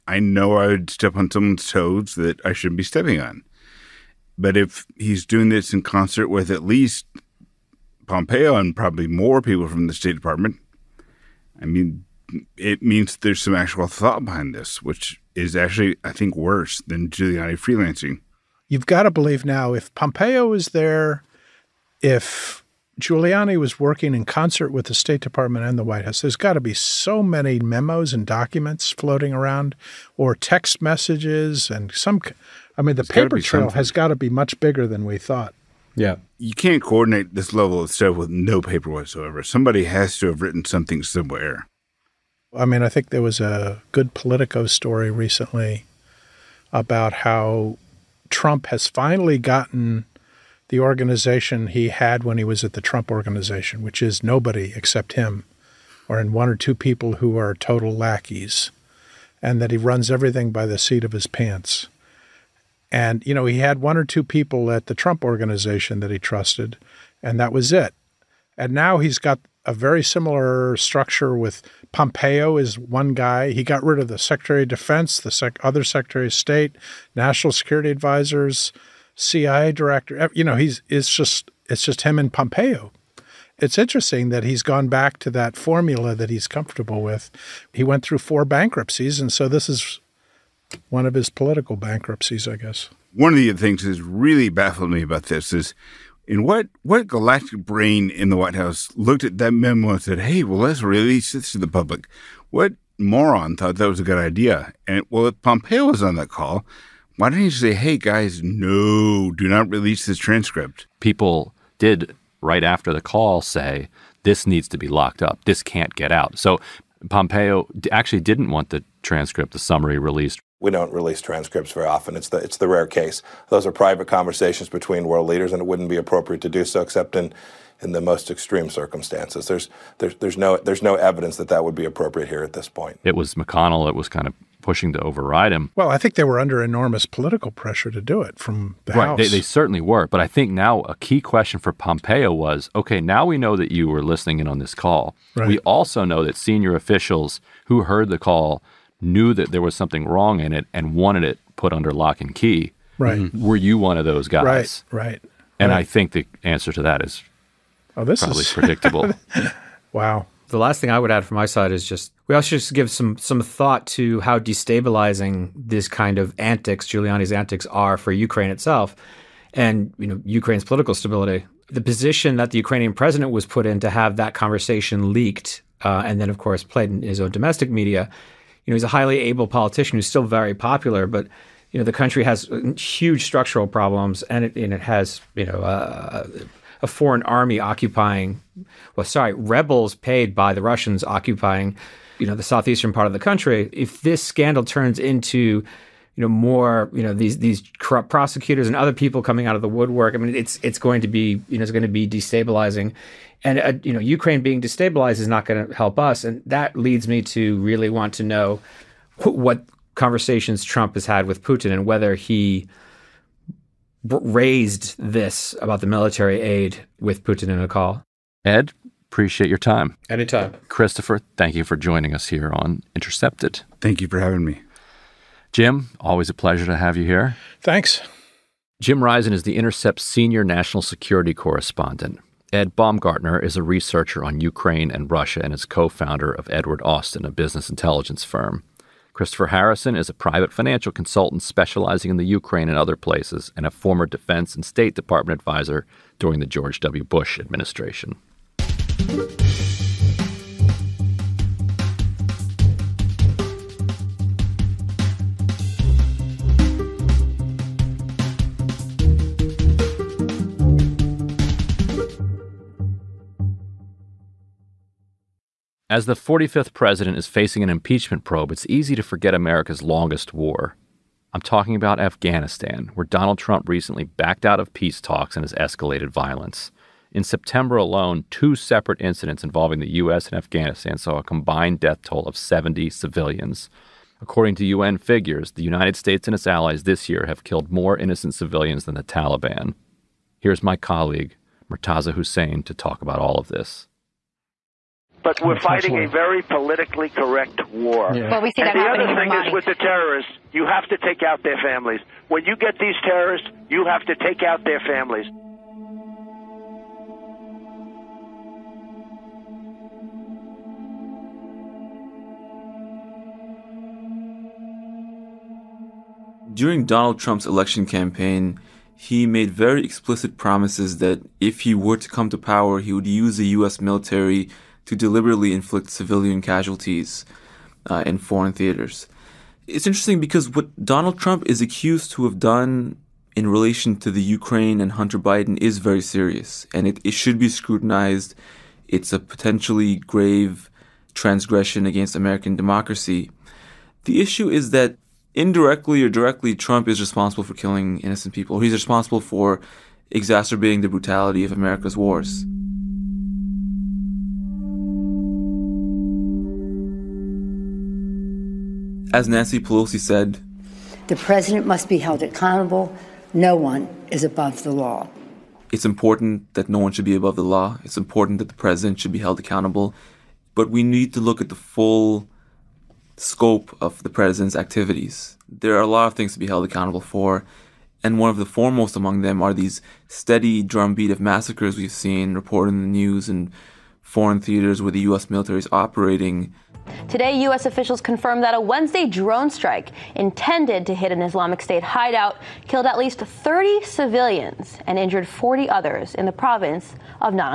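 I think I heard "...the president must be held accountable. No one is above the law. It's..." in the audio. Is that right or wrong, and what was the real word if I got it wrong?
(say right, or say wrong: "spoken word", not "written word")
right.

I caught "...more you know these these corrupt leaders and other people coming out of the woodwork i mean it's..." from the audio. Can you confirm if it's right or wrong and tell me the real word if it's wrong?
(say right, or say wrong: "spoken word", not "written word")
wrong: "prosecutors", not "leaders".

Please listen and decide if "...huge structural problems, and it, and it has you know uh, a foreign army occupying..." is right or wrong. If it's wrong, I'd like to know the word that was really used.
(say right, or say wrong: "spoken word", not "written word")
right.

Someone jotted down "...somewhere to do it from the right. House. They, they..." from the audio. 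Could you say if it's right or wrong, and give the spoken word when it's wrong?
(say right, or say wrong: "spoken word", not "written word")
wrong: "pressure", not "somewhere".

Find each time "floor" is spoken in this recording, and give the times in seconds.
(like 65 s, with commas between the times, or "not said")
not said.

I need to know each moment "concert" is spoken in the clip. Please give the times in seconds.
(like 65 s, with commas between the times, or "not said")
5 s, 24 s.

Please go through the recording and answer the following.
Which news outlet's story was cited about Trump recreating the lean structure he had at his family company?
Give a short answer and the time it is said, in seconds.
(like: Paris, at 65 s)
Politico, at 44 s.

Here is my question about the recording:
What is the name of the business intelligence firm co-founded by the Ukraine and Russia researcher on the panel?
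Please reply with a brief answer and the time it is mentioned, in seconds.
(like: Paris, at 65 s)
Edward Austin, at 236 s.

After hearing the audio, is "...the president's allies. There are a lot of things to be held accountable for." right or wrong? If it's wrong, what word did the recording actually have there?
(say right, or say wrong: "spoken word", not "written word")
wrong: "activities", not "allies".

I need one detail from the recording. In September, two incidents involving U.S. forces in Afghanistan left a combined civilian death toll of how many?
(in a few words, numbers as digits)
70.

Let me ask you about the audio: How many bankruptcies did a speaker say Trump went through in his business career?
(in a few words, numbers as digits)
4.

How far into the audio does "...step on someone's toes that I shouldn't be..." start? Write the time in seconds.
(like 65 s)
0 s.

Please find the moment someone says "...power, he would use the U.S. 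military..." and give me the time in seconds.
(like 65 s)
322 s.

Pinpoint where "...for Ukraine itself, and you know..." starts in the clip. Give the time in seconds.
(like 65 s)
167 s.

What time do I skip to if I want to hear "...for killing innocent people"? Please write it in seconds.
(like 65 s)
347 s.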